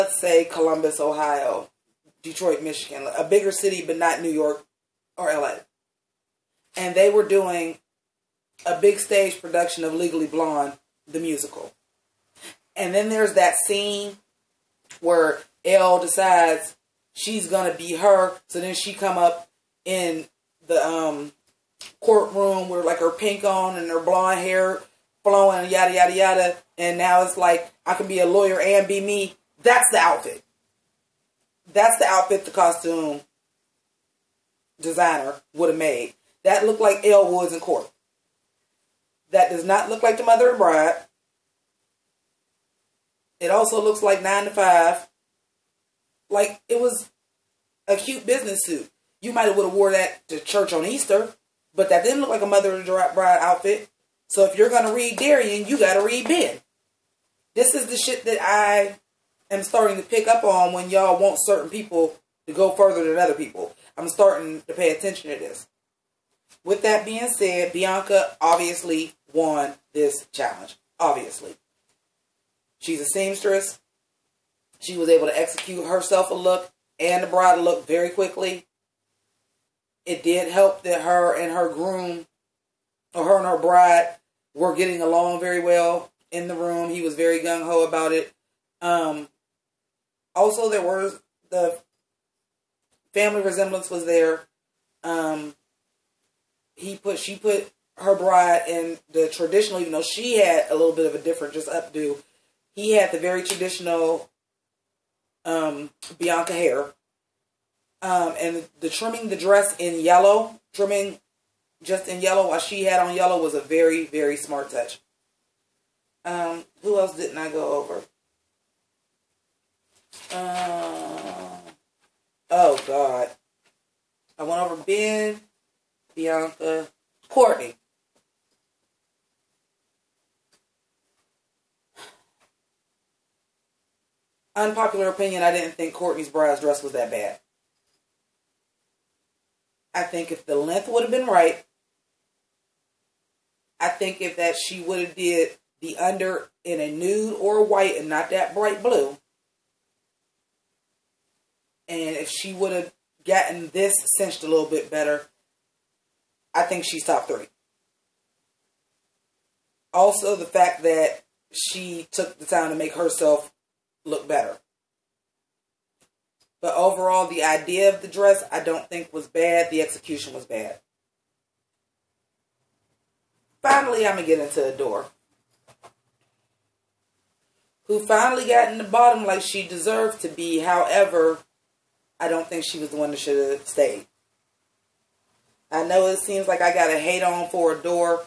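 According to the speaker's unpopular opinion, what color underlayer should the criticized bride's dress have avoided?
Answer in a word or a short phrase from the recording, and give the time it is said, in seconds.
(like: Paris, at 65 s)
Bright blue, at 148 s.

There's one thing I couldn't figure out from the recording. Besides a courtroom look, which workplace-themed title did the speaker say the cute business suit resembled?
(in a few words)
Nine to Five.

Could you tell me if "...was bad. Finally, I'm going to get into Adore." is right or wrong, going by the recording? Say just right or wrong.
right.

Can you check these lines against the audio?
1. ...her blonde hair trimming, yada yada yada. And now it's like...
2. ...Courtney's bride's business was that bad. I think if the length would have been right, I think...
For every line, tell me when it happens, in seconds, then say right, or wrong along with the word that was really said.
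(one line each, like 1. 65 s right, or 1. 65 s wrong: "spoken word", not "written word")
1. 23 s wrong: "flowing", not "trimming"
2. 135 s wrong: "dress", not "business".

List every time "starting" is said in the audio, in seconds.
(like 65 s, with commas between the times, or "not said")
59 s, 64 s.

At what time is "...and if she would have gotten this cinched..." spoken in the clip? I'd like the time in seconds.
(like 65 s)
151 s.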